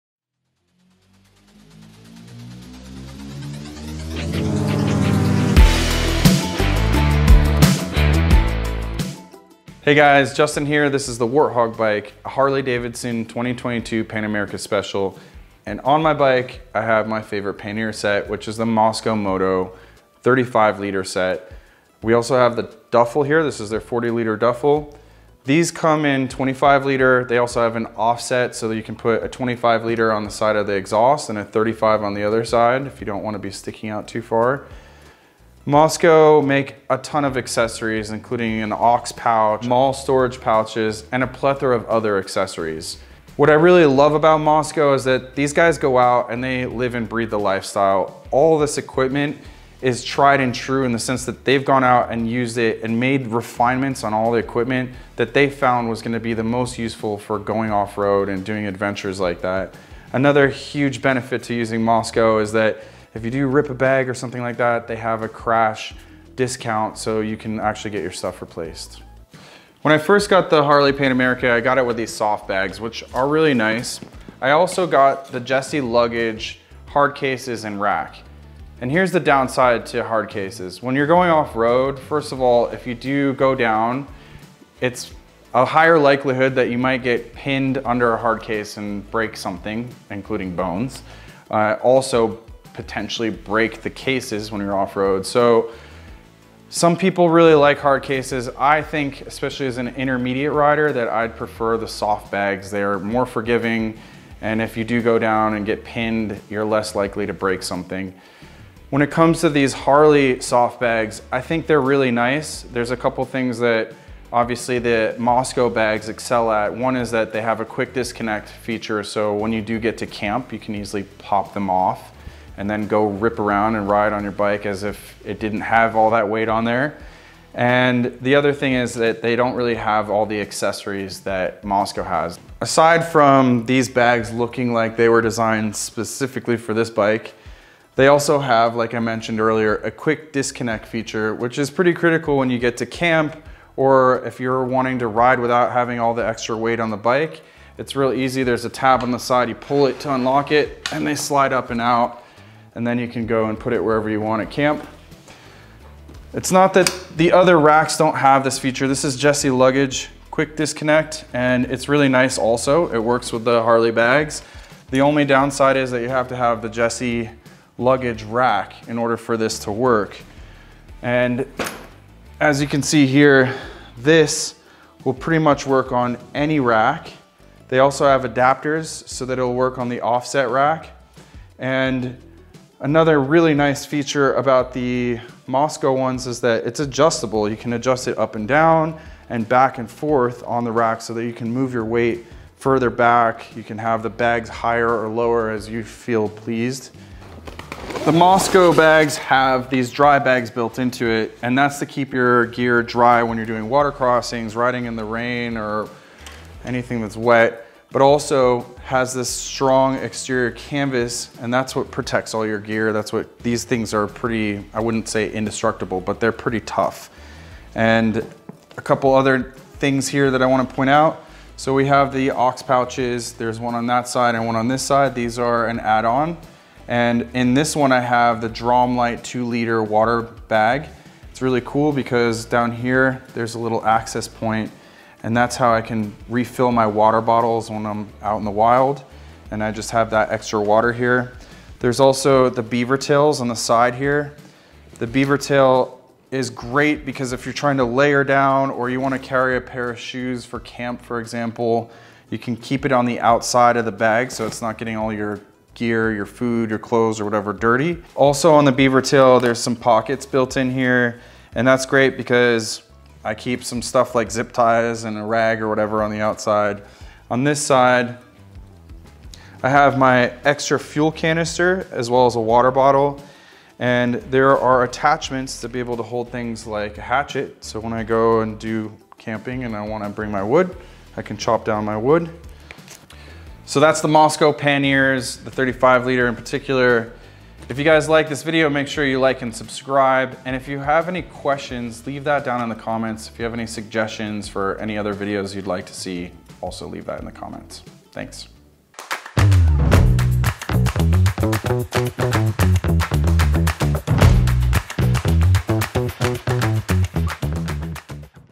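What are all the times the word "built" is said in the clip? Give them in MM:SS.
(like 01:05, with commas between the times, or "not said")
03:20, 04:20.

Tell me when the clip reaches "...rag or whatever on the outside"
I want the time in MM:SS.
04:25.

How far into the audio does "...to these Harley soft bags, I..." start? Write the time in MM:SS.
01:49.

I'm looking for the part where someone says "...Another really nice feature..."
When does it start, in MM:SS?
03:02.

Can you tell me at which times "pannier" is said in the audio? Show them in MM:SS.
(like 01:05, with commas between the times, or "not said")
00:17, 04:44.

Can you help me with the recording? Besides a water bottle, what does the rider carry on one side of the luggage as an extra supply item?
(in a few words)
fuel canister.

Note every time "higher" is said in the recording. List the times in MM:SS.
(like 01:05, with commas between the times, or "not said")
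01:25, 03:14.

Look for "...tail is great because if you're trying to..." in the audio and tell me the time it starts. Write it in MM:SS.
04:05.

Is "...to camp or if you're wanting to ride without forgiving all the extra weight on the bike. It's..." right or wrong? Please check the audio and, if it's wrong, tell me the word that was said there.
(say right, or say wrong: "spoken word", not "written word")
wrong: "having", not "forgiving".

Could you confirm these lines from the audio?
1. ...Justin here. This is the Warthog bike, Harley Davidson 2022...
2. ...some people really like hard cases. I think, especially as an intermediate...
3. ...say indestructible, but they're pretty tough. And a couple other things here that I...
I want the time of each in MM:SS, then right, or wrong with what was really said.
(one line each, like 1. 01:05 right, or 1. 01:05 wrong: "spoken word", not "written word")
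1. 00:10 right
2. 01:36 right
3. 03:35 right.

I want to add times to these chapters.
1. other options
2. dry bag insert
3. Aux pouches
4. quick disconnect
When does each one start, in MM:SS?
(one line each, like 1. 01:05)
1. 01:09
2. 03:20
3. 03:40
4. 02:22.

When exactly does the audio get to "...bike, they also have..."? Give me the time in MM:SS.
02:16.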